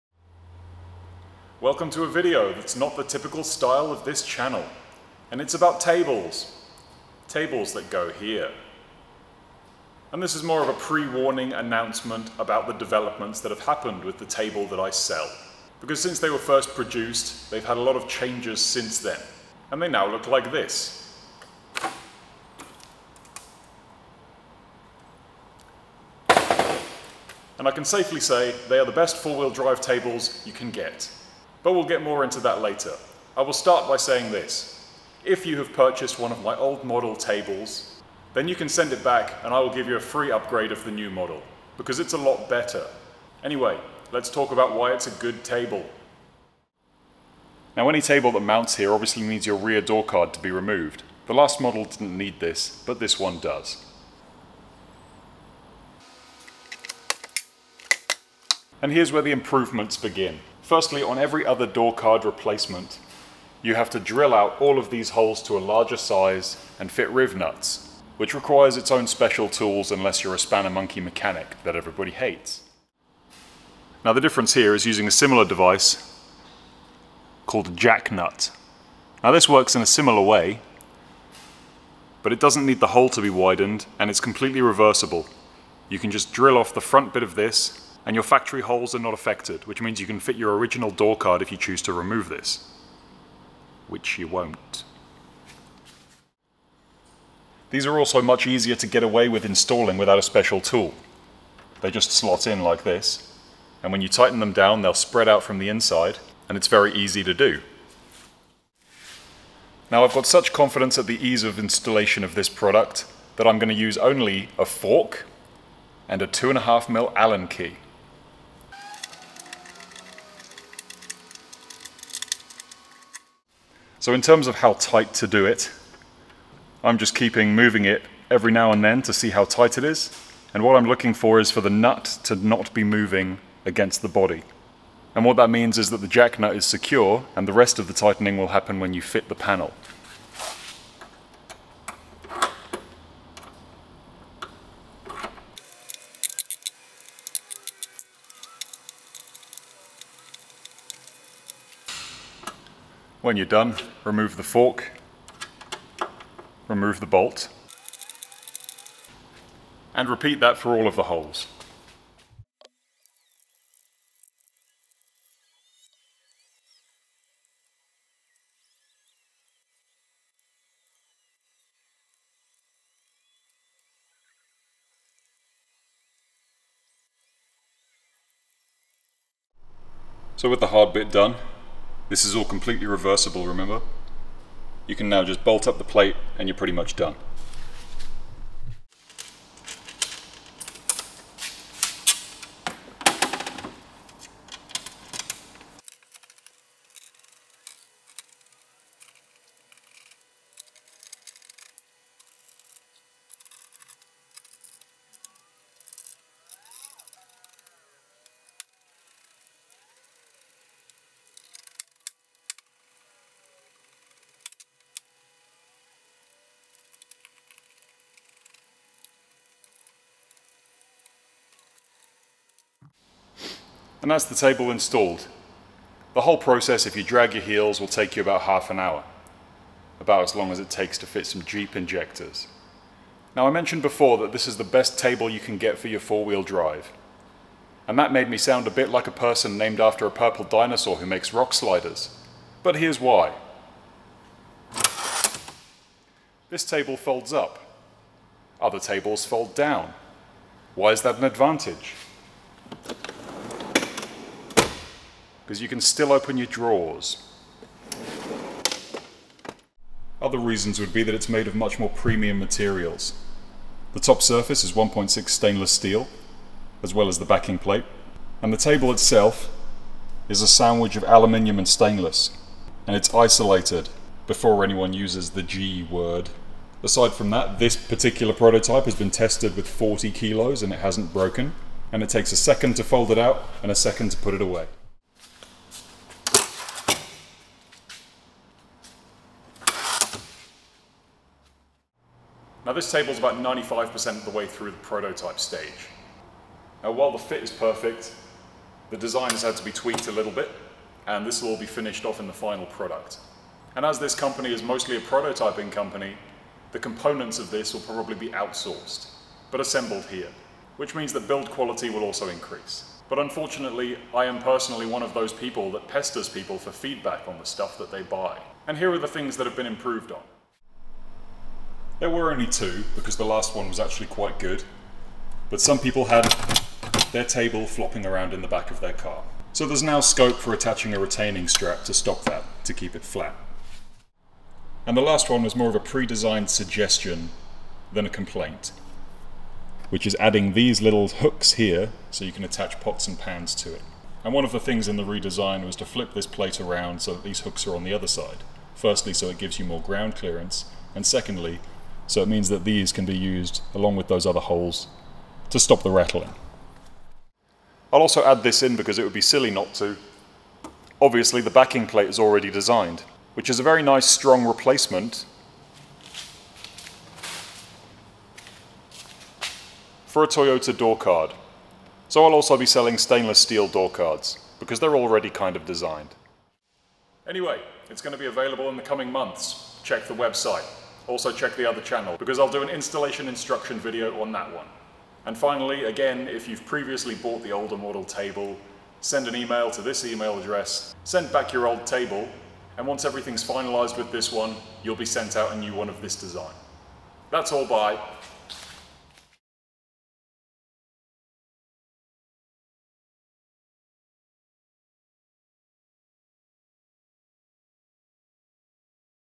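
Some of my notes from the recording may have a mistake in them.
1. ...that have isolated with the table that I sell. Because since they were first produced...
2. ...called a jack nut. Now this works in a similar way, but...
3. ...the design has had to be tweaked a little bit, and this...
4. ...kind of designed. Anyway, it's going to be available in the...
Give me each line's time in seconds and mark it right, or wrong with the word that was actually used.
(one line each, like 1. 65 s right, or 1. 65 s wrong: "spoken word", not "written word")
1. 13 s wrong: "happened", not "isolated"
2. 77 s right
3. 298 s right
4. 375 s right.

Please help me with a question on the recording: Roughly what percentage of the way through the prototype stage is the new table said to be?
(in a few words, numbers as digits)
95%.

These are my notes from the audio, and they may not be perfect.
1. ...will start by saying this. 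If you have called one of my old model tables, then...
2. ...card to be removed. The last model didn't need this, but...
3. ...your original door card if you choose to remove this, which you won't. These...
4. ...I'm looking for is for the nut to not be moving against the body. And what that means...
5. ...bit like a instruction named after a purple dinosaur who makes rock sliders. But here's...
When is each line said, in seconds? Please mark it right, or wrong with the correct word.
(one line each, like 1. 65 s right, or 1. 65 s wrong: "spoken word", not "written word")
1. 33 s wrong: "purchased", not "called"
2. 50 s right
3. 90 s right
4. 130 s right
5. 238 s wrong: "person", not "instruction".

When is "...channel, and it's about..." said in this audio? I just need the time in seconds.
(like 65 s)
4 s.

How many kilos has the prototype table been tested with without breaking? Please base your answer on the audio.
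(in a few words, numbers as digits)
40.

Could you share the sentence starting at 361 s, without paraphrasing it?
Obviously the backing plate is already designed, which is a very nice strong replacement for a Toyota door card.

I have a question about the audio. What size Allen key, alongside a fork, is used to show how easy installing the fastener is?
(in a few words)
2.5mm.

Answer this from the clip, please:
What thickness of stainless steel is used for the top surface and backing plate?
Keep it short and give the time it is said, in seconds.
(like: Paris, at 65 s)
1.6, at 264 s.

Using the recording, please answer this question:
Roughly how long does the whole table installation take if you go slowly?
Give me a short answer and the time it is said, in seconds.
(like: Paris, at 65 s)
half an hour, at 228 s.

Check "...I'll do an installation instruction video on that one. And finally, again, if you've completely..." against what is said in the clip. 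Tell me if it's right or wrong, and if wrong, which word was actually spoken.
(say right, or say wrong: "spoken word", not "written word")
wrong: "previously", not "completely".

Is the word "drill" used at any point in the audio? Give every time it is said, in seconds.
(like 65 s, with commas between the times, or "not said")
63 s, 86 s.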